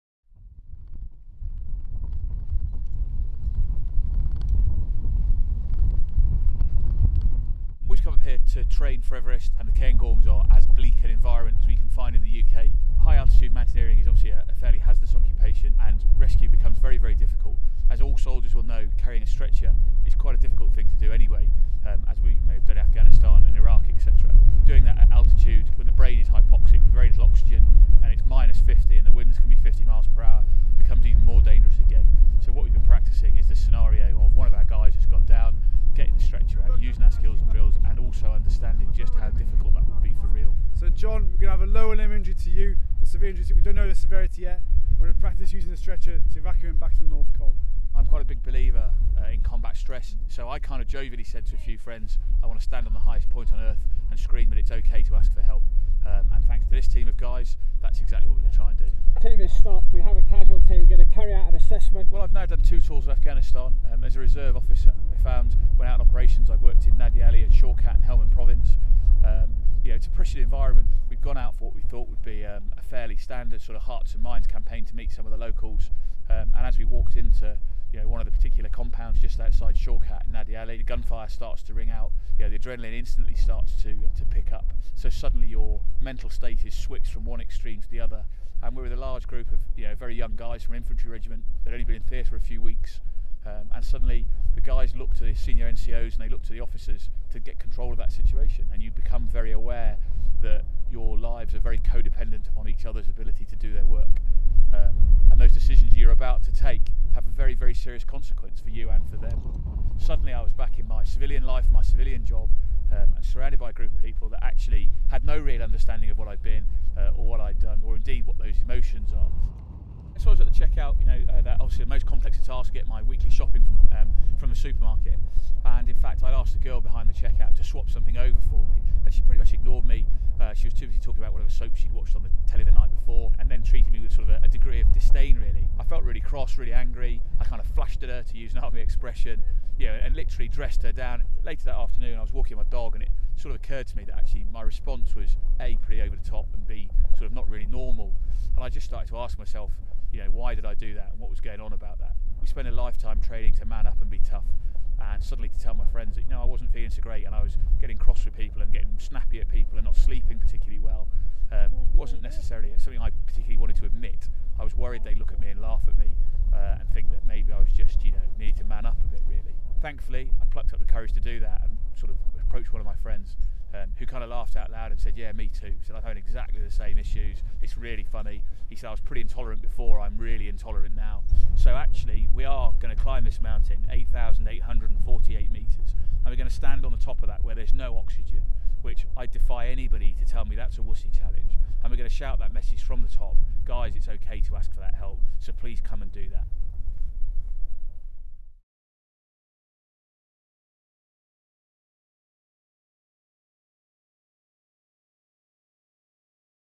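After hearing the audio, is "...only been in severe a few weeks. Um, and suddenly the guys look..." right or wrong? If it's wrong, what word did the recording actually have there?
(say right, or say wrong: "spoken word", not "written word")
wrong: "theatre", not "severe".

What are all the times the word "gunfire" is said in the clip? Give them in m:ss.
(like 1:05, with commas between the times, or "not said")
1:20.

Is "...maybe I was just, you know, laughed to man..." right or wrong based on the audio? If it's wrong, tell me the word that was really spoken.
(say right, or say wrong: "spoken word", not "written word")
wrong: "needed", not "laughed".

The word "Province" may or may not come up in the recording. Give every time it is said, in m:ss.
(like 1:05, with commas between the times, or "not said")
1:08.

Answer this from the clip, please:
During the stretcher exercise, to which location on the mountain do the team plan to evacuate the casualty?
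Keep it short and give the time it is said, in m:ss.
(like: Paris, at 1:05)
North Col, at 0:47.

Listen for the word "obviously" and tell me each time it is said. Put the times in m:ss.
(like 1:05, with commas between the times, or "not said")
0:14, 2:01.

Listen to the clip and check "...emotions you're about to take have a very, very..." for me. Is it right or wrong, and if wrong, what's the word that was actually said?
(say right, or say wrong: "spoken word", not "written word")
wrong: "decisions", not "emotions".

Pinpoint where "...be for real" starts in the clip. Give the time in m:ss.
0:40.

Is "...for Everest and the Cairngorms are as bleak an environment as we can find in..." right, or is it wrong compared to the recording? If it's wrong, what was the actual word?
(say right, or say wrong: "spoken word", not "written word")
right.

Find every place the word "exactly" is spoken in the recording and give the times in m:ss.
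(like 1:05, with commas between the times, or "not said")
0:58, 2:56.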